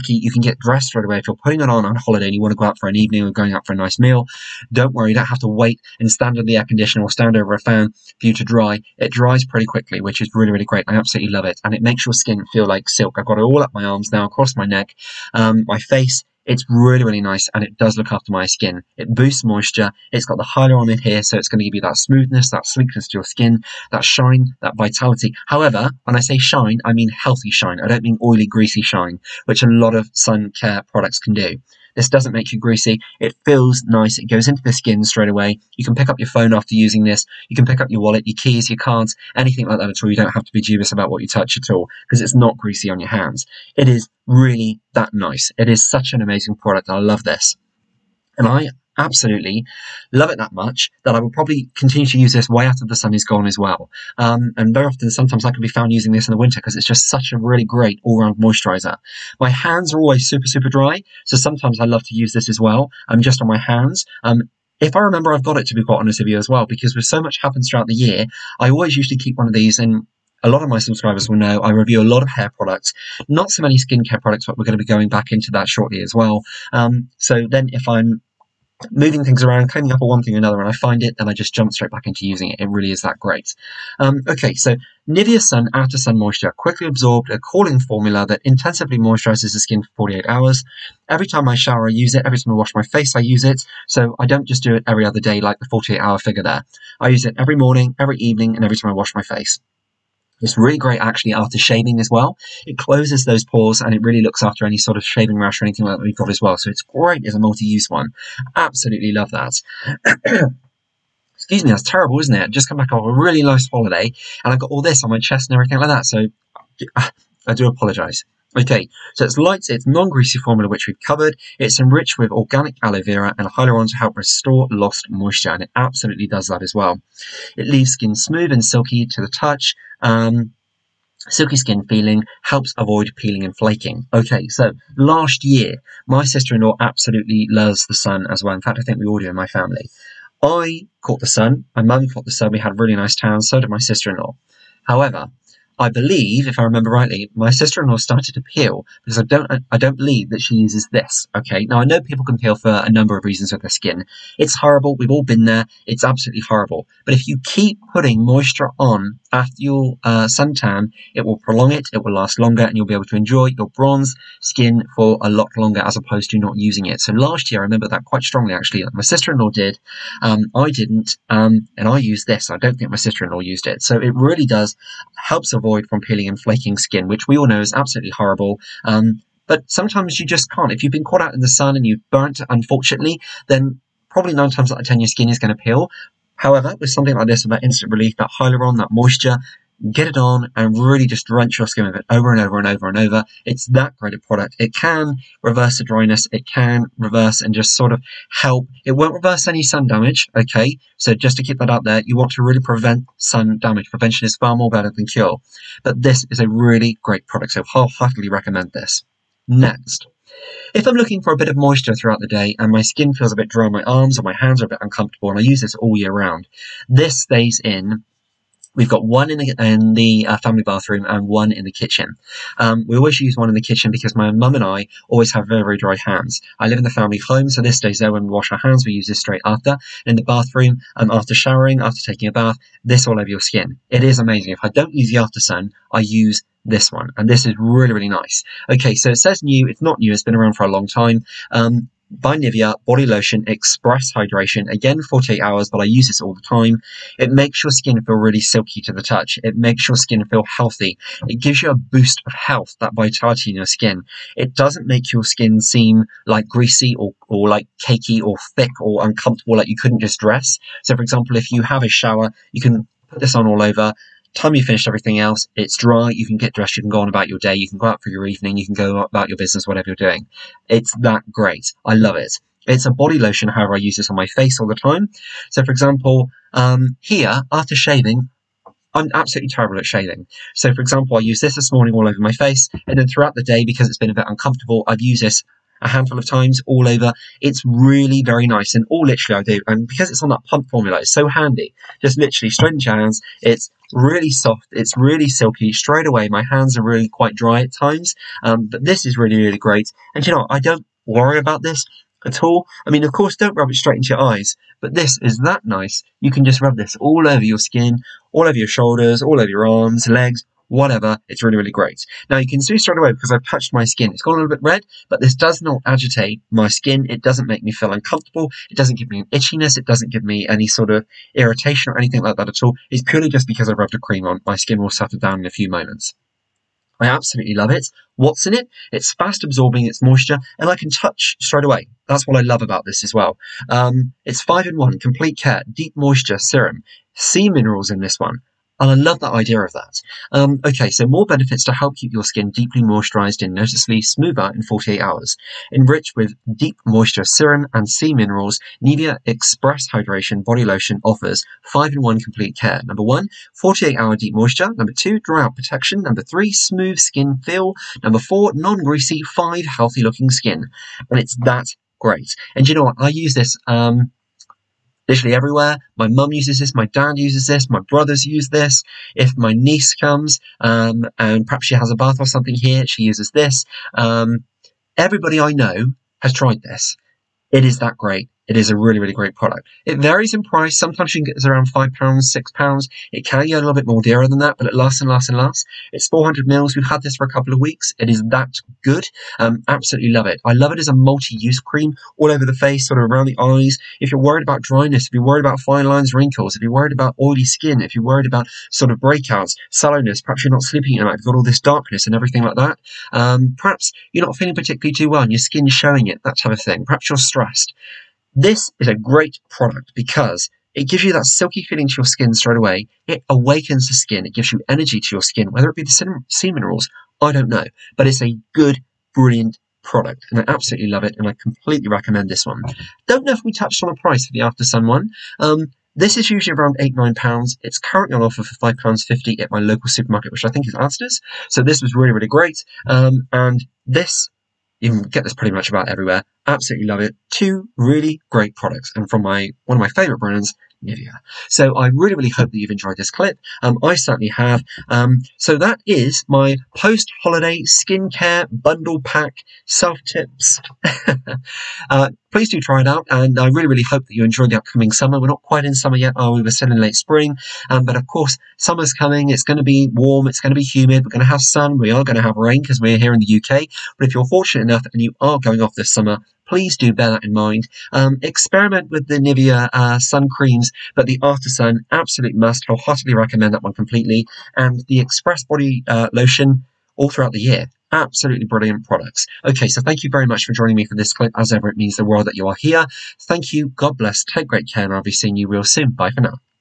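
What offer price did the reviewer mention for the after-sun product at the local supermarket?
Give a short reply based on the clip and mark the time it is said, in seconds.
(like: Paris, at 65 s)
£5.50, at 428 s.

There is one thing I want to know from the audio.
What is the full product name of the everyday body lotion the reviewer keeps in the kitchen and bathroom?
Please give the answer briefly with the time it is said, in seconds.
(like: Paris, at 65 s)
Nivea Body Lotion Express Hydration, at 242 s.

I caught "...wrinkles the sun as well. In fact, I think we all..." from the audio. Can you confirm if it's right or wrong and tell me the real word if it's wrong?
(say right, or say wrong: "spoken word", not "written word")
wrong: "loves", not "wrinkles".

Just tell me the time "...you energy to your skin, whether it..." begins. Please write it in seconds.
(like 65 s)
414 s.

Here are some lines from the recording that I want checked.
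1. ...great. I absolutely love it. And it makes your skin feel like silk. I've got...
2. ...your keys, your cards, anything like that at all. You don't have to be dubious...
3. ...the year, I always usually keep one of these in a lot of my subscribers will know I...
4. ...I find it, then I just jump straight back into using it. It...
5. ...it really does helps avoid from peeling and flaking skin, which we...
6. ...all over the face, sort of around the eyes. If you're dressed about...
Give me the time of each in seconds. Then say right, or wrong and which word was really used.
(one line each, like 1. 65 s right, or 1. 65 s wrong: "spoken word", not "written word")
1. 10 s right
2. 38 s right
3. 67 s right
4. 80 s right
5. 173 s right
6. 392 s wrong: "worried", not "dressed".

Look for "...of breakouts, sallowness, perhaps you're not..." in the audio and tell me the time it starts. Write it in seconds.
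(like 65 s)
398 s.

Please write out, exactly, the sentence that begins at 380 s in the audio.
Sometimes you can get this around £5, £6.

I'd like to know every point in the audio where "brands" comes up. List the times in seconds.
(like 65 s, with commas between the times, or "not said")
440 s.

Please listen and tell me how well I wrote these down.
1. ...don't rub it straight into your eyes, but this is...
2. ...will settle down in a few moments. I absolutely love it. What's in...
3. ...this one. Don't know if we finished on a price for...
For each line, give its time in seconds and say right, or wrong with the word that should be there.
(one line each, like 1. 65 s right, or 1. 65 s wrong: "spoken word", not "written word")
1. 303 s right
2. 324 s right
3. 422 s wrong: "touched", not "finished".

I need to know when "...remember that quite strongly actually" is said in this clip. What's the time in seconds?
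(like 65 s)
167 s.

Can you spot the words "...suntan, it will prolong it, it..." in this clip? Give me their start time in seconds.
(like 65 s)
160 s.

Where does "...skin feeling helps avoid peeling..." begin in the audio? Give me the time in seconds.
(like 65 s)
131 s.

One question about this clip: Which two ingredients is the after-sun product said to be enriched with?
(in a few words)
aloe vera and hyaluron.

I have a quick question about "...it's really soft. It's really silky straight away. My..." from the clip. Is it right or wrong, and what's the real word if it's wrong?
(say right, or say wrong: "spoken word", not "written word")
right.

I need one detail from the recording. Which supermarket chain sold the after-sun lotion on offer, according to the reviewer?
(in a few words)
Asda.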